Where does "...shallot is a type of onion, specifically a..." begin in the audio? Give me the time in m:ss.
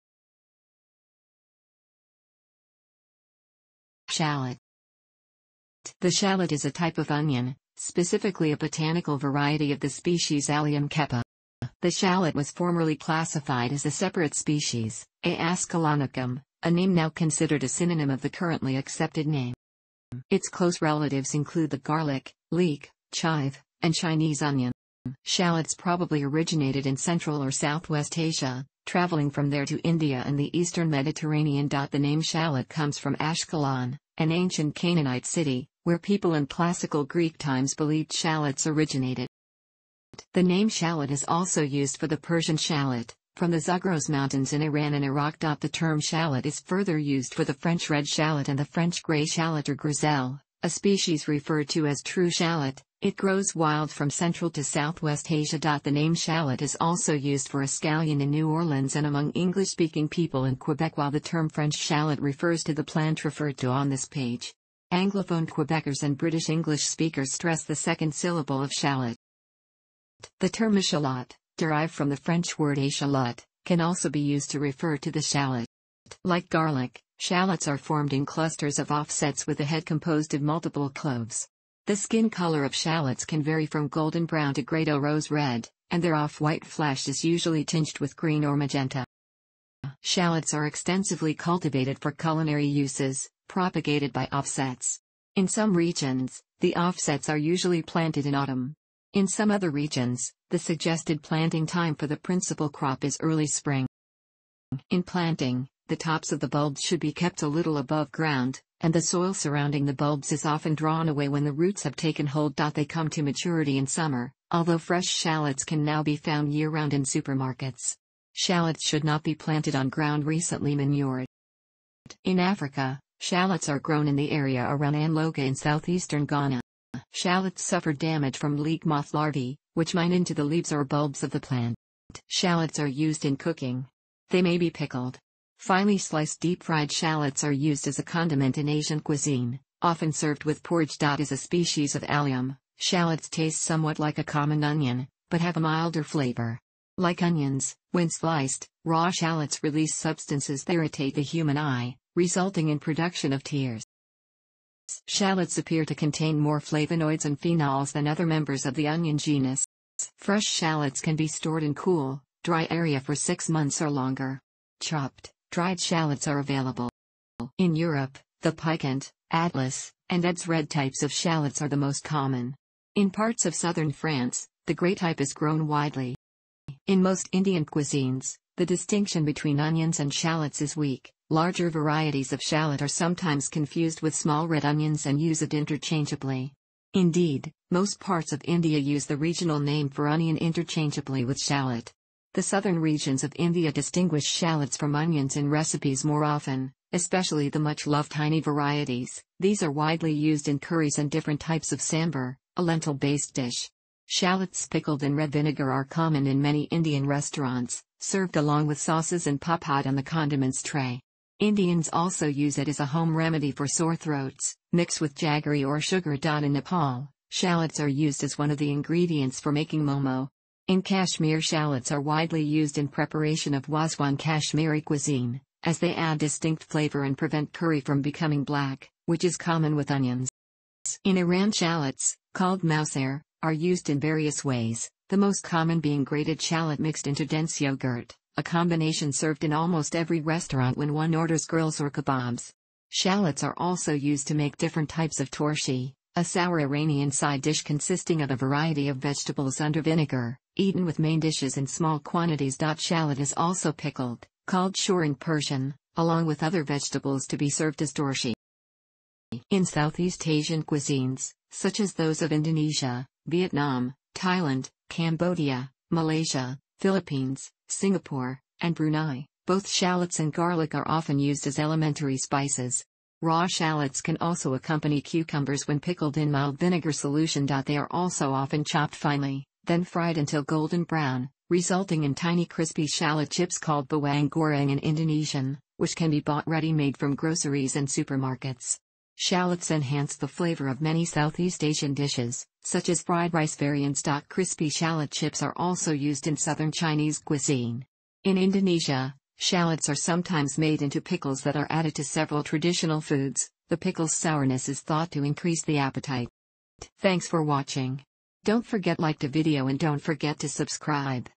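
0:06.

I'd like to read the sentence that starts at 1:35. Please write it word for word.
In some regions, the offsets are usually planted in autumn.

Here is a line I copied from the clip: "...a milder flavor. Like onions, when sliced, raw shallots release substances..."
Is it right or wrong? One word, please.
right.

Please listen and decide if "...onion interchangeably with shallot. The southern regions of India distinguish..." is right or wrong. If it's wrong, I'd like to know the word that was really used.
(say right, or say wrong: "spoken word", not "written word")
right.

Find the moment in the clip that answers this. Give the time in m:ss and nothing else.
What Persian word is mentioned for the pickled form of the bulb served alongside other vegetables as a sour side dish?
4:14.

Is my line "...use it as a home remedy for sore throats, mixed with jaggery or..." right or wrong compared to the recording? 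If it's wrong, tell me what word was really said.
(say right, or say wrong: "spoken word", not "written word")
right.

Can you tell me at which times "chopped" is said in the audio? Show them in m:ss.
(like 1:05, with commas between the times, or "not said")
2:44, 4:38.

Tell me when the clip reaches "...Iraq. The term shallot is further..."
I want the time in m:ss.
0:45.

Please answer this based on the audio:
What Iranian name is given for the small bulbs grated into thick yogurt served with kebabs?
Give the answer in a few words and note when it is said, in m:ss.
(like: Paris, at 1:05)
mousair, at 3:52.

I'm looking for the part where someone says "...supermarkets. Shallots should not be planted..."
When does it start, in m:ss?
1:57.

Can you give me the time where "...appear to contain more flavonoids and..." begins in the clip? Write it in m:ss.
2:35.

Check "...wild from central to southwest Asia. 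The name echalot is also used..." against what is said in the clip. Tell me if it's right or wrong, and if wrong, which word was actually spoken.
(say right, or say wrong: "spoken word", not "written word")
wrong: "shallot", not "echalot".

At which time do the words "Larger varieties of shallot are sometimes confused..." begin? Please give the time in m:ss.
3:01.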